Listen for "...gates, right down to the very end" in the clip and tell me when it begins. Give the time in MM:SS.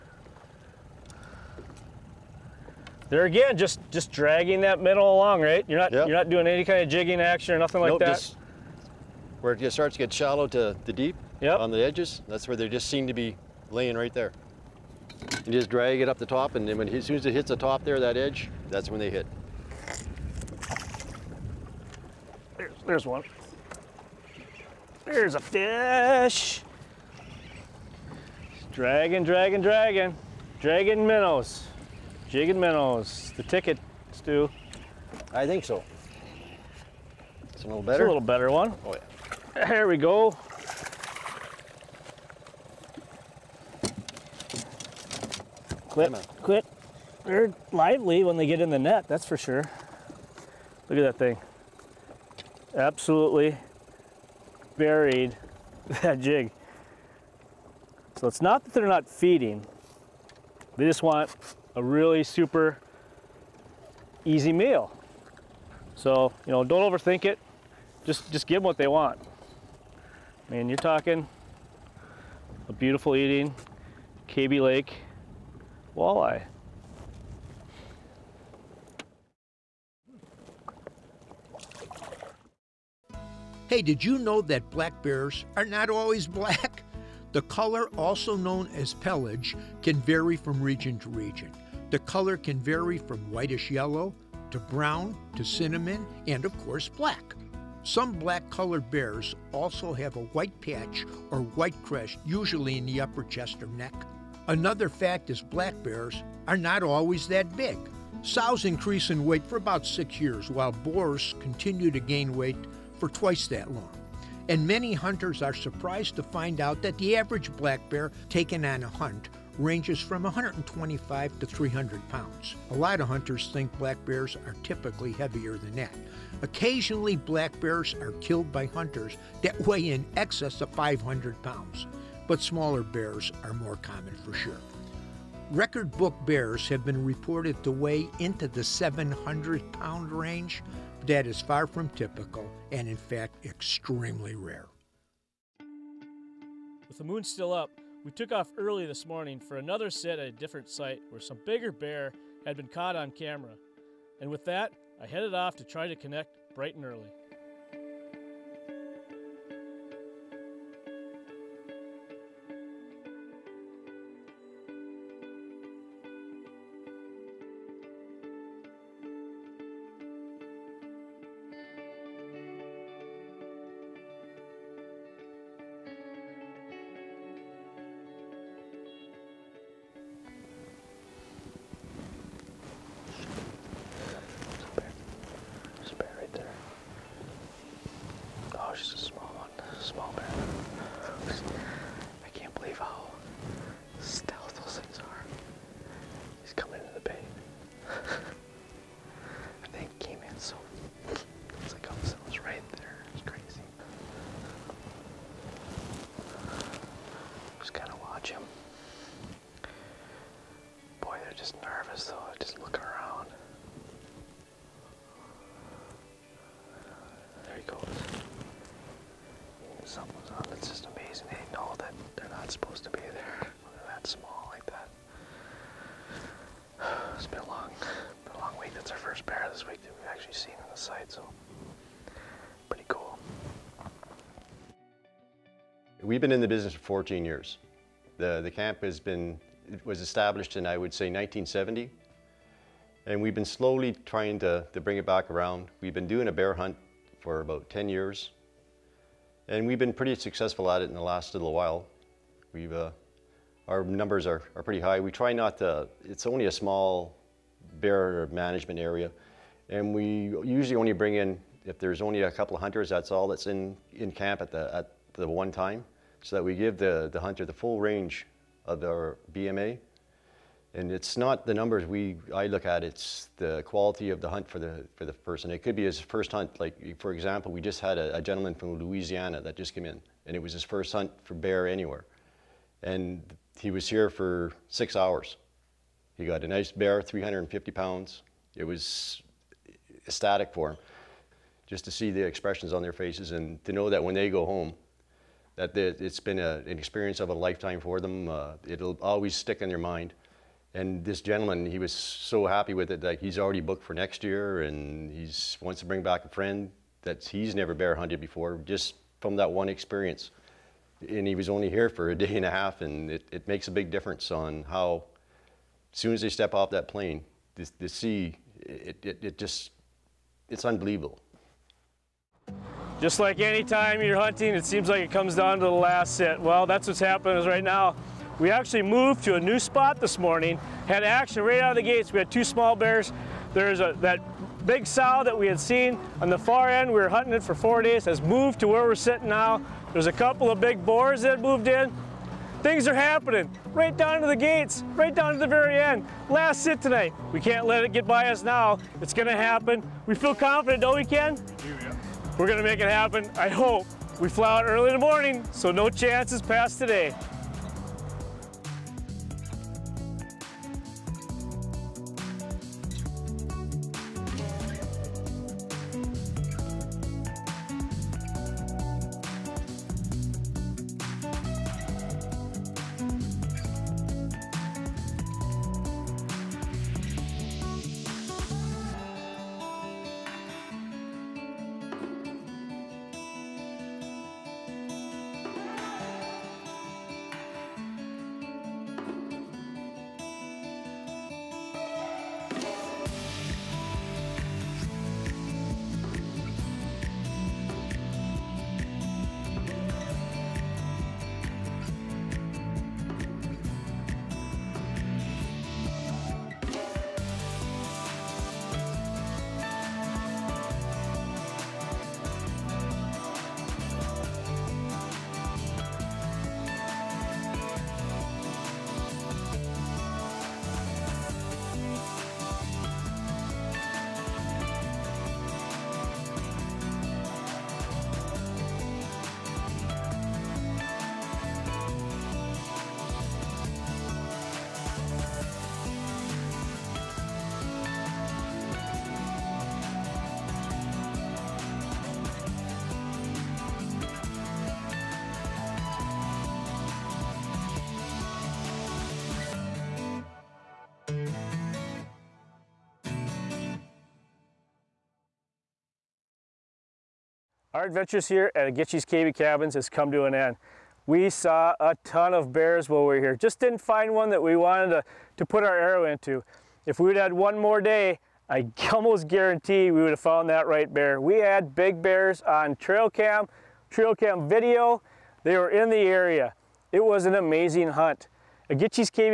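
05:44.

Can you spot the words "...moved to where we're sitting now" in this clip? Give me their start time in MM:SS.
05:38.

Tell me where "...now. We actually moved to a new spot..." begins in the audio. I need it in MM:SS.
05:27.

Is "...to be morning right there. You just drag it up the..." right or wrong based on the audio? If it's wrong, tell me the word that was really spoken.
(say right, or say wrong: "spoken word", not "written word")
wrong: "laying", not "morning".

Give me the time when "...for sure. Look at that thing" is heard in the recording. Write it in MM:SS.
00:49.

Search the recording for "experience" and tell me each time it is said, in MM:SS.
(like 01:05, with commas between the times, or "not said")
04:56, 05:09.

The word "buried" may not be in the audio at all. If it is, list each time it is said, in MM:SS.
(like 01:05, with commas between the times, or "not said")
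00:54.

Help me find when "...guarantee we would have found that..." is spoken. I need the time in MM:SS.
07:49.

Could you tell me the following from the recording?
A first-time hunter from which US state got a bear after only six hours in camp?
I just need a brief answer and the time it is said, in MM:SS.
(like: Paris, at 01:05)
Louisiana, at 04:38.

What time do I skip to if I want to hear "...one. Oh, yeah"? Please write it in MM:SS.
00:38.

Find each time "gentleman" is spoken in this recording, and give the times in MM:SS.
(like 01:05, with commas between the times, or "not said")
04:38, 05:01.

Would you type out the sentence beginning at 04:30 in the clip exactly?
And it's not the numbers we, I look at, it's the quality of the hunt for the, for the person.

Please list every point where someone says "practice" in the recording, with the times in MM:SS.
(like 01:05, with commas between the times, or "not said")
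not said.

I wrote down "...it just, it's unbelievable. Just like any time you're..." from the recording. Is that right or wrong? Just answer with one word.
right.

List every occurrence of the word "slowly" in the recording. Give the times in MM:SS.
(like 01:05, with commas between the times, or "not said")
04:03.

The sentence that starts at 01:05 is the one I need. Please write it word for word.
So, you know, don't overthink it.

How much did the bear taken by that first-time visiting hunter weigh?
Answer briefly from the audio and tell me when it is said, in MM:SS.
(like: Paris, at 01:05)
350 pounds, at 04:47.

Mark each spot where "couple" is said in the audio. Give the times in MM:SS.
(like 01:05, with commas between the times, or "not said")
04:22, 05:40.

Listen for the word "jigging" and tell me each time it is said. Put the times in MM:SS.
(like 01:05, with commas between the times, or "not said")
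00:06, 00:32.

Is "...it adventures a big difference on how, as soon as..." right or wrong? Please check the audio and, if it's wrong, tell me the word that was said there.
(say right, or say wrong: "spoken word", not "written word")
wrong: "makes", not "adventures".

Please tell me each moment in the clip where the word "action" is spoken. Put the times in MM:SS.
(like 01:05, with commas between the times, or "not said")
00:07, 05:31.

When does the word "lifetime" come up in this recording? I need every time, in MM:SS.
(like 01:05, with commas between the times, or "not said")
04:57.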